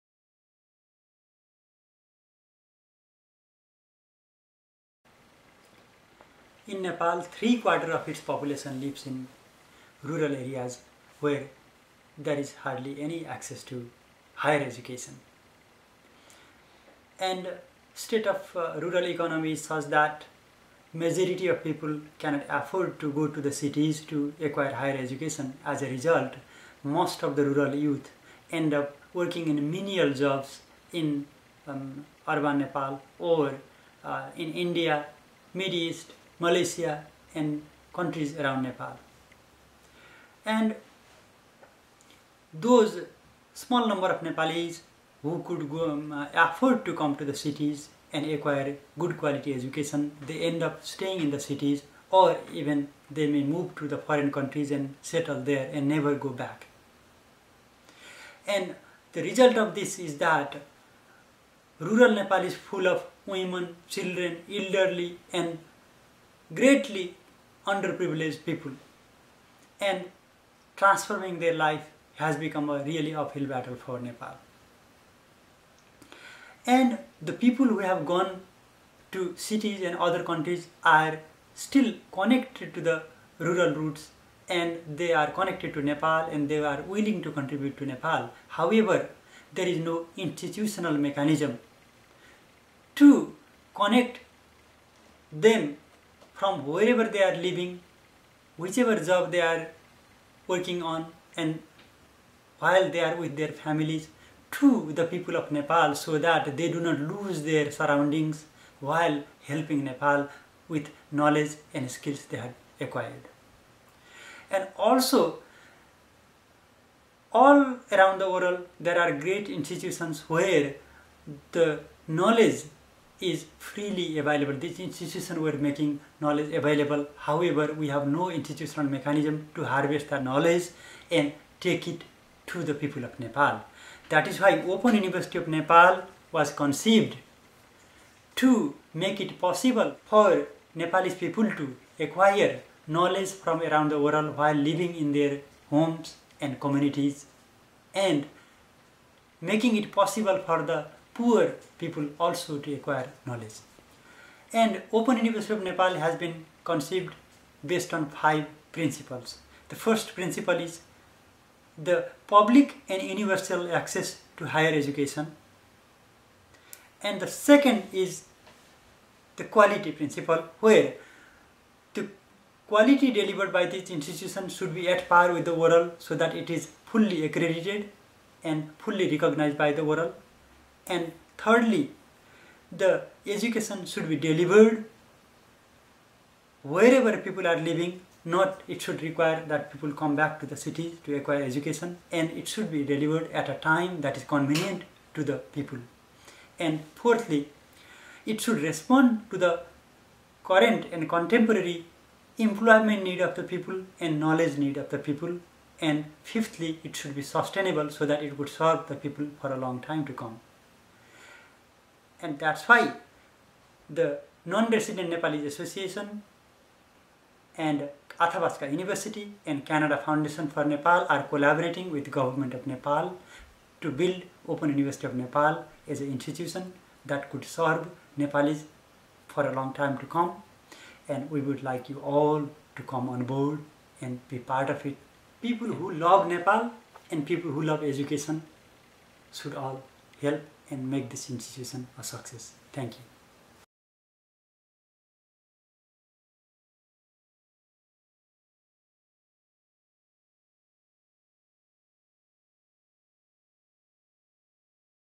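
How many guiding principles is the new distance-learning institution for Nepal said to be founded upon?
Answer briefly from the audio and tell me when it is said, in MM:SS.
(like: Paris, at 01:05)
5, at 02:38.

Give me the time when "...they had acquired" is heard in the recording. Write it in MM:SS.
01:52.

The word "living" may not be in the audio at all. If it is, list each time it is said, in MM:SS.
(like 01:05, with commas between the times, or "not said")
01:37, 02:24, 03:07.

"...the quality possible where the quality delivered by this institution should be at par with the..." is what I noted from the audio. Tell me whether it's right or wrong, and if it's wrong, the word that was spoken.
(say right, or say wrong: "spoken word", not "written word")
wrong: "principle", not "possible".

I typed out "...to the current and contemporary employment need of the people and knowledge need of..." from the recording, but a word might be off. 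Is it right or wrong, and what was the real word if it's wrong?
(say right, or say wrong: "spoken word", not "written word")
right.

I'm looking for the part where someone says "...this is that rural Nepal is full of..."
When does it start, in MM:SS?
00:59.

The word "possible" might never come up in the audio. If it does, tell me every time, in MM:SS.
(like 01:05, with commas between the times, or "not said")
02:19, 02:29.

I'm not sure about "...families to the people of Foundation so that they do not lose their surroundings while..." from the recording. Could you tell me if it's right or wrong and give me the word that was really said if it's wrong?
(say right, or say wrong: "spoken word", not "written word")
wrong: "Nepal", not "Foundation".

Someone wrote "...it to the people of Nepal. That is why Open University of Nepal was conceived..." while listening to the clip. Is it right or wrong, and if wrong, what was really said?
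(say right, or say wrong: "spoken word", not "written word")
right.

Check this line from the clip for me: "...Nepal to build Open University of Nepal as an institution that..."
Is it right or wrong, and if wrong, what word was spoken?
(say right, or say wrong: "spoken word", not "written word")
right.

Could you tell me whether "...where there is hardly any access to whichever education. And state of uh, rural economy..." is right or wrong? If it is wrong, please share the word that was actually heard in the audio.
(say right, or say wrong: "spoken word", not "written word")
wrong: "higher", not "whichever".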